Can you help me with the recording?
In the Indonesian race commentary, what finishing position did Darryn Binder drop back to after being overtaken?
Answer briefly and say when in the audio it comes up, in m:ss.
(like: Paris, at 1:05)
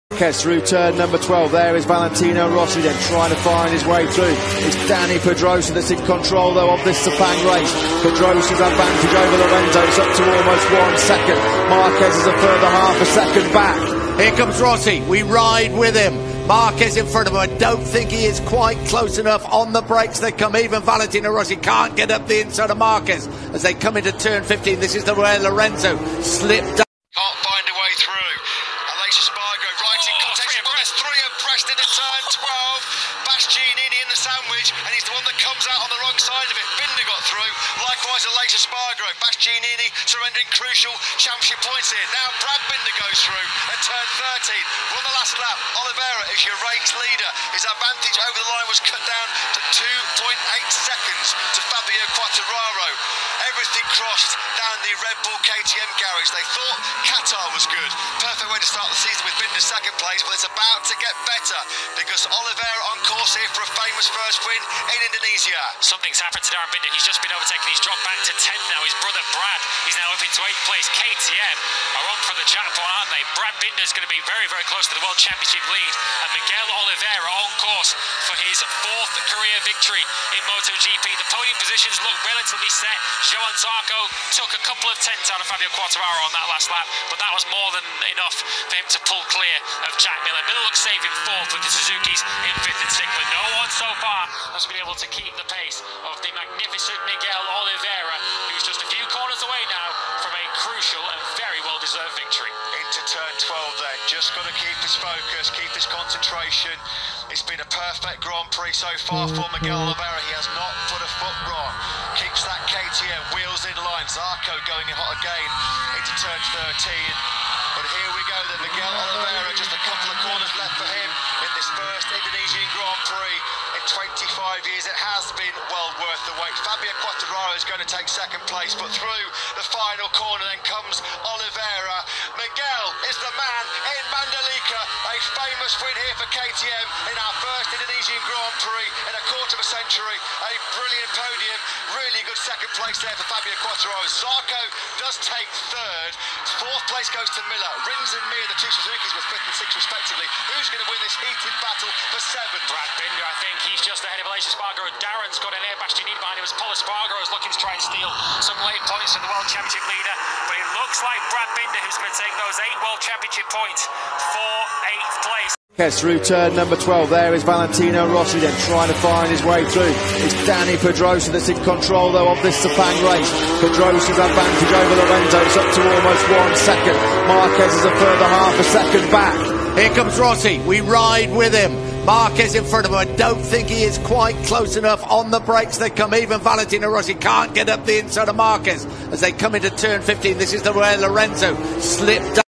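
10th, at 1:08.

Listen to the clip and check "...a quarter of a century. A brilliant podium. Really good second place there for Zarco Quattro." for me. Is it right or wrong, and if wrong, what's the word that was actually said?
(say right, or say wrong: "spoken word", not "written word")
wrong: "Fabio", not "Zarco".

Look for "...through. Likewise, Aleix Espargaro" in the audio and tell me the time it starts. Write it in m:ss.
0:37.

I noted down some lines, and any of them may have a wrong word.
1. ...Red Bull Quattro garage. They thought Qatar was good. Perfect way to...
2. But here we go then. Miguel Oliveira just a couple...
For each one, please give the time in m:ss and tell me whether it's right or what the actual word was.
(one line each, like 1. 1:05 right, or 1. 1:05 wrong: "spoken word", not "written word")
1. 0:55 wrong: "KTM", not "Quattro"
2. 1:57 right.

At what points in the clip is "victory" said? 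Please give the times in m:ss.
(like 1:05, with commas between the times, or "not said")
1:19, 1:42.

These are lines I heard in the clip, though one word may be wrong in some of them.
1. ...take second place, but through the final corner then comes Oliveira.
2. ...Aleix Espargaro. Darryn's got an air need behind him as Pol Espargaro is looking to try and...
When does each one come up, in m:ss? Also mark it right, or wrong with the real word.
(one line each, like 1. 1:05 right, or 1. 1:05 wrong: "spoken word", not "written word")
1. 2:07 right
2. 2:34 right.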